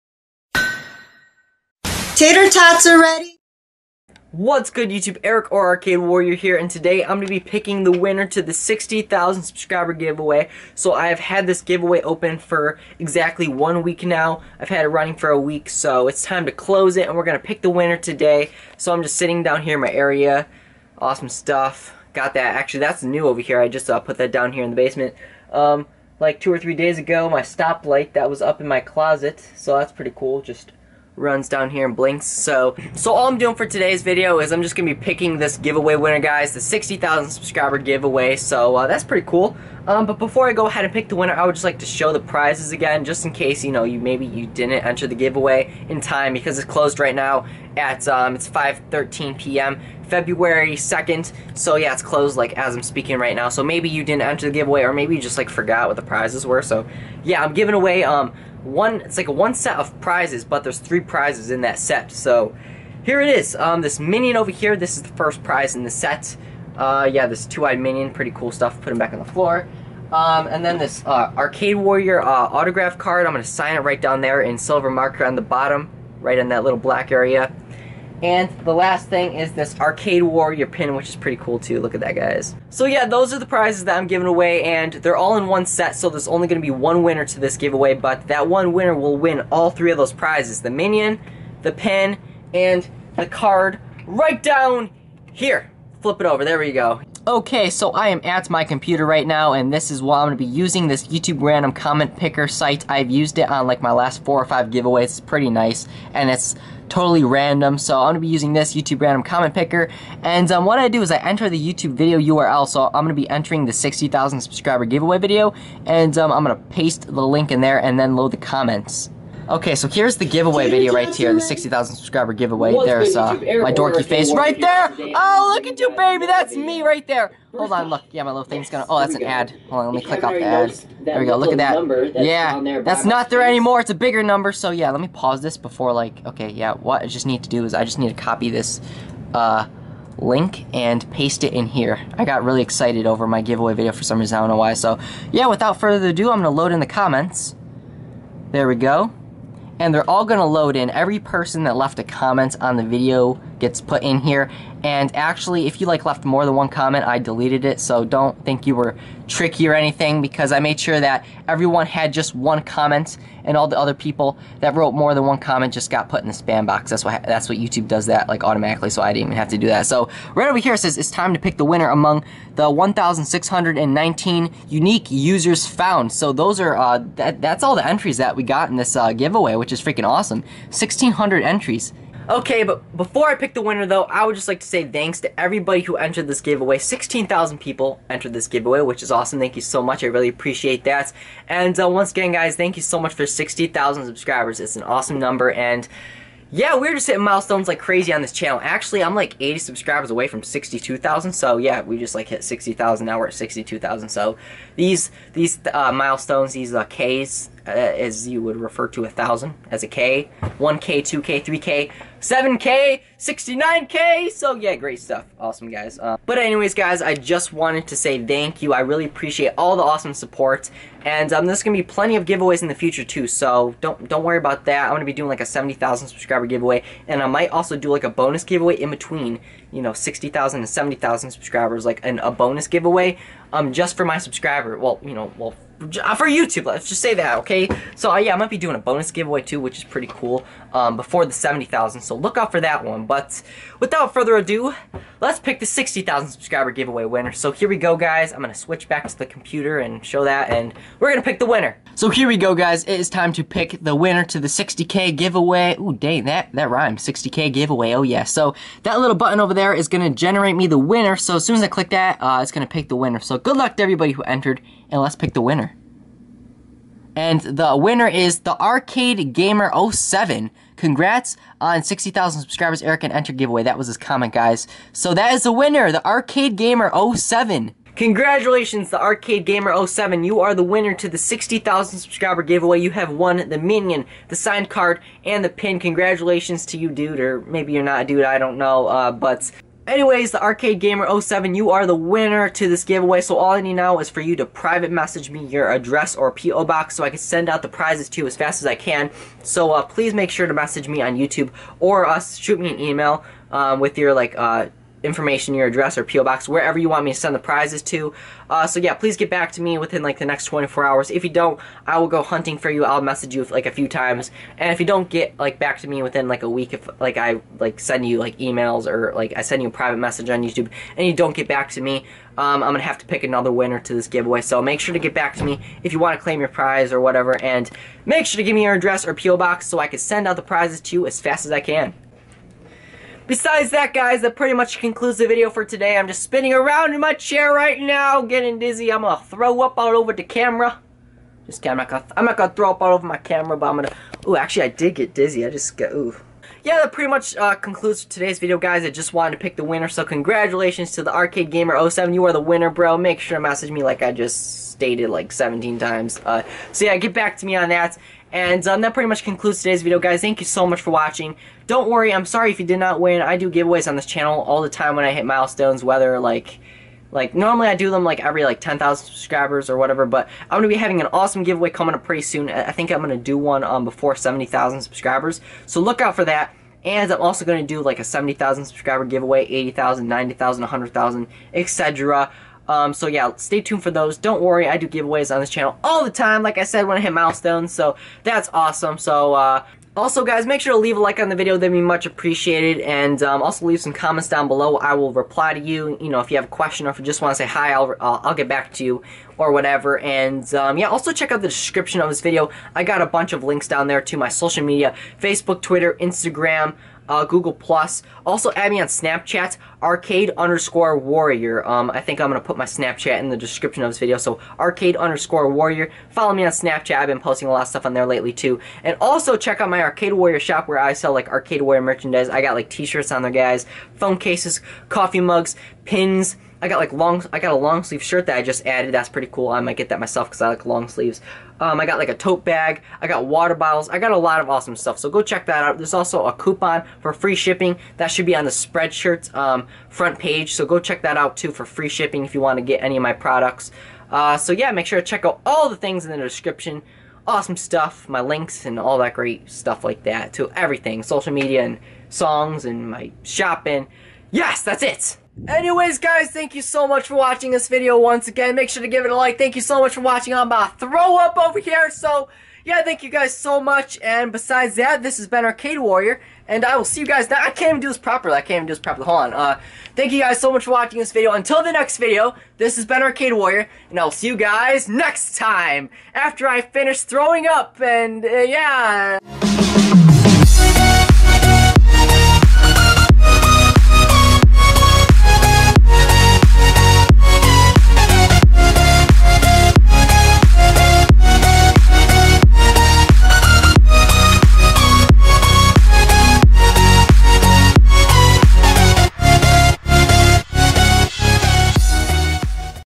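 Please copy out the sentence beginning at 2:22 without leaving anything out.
I got really excited over my giveaway video for some reason, I don't know why.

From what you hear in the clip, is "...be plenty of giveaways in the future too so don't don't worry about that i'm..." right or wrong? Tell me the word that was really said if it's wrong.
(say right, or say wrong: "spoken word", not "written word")
right.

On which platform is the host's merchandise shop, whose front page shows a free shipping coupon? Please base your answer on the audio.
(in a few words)
Spreadshirt.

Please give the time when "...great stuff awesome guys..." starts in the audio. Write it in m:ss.
3:34.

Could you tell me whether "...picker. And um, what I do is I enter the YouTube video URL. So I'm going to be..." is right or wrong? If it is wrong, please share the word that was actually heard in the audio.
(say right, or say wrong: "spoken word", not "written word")
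right.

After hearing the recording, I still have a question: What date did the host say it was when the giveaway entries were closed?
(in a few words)
February 2nd.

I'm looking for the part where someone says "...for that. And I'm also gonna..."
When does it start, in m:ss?
6:16.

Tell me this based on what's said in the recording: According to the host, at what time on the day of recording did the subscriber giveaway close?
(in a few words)
5:13 p.m.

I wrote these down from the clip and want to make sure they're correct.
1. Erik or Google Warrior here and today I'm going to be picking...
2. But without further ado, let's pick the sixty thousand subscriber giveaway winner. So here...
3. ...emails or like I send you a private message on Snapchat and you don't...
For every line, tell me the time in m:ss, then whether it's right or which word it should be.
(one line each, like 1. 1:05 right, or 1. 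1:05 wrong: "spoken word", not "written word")
1. 0:05 wrong: "Arcade", not "Google"
2. 4:03 right
3. 5:18 wrong: "YouTube", not "Snapchat".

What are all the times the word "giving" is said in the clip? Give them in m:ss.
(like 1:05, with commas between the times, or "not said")
0:57, 1:24.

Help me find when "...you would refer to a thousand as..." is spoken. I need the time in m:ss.
3:28.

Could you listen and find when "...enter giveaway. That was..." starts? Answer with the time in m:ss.
4:33.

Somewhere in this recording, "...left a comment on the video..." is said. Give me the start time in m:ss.
2:31.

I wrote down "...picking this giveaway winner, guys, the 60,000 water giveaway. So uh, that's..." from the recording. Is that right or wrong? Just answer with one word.
wrong.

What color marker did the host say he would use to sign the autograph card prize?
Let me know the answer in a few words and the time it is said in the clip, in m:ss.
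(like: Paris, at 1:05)
silver, at 1:14.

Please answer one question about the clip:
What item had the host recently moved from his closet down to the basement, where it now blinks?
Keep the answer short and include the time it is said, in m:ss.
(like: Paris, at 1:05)
stoplight, at 0:27.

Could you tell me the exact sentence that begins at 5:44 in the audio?
Ooh, actually, I did get dizzy.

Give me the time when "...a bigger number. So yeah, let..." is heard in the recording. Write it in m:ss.
2:13.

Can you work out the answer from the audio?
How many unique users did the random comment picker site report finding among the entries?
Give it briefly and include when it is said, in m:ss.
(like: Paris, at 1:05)
1,619, at 2:52.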